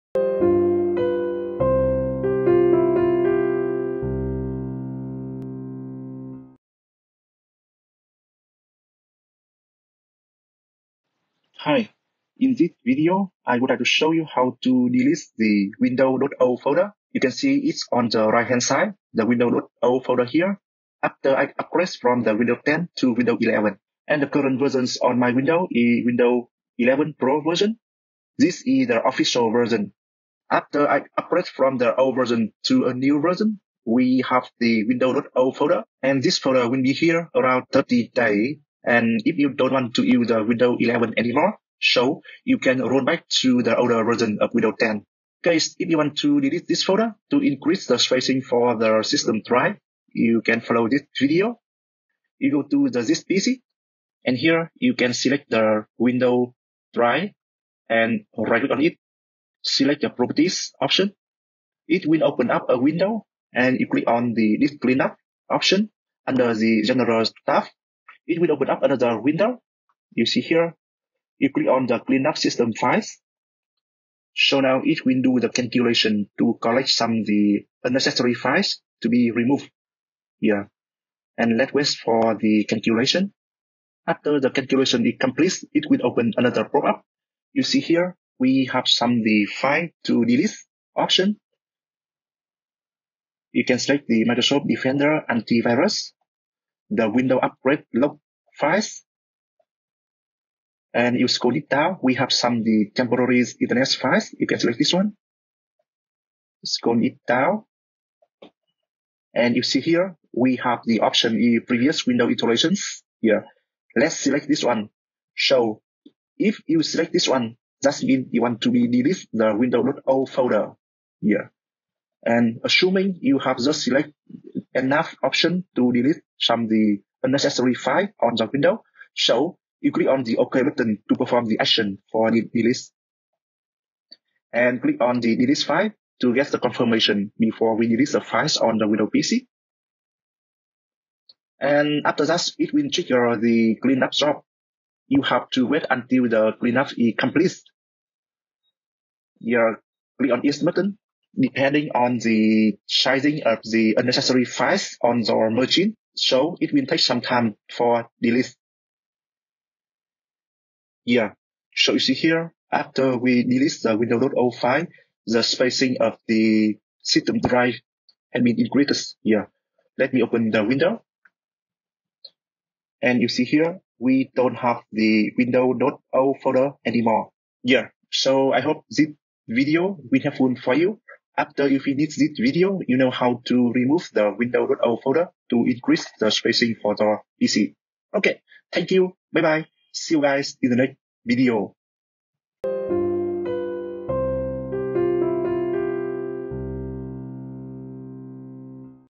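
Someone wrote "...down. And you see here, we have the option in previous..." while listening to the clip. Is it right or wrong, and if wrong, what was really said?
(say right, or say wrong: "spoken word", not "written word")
right.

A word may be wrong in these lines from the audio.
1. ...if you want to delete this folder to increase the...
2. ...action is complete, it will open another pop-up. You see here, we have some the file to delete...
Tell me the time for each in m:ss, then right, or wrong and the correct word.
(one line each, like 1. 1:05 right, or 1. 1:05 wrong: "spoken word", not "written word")
1. 0:45 right
2. 1:24 wrong: "calculation", not "action".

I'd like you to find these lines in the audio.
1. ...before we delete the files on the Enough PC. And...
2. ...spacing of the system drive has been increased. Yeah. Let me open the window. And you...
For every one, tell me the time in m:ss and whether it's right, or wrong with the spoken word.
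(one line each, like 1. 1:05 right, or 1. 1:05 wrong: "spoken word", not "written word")
1. 2:17 wrong: "Windows", not "Enough"
2. 2:45 right.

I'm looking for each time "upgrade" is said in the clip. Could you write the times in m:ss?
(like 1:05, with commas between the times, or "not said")
0:21, 0:31, 1:37.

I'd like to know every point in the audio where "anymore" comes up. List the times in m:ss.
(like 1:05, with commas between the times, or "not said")
0:41, 2:56.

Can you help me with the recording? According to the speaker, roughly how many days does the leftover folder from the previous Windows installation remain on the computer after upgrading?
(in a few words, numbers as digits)
30 days.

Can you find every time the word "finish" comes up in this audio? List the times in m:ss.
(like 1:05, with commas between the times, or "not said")
3:01.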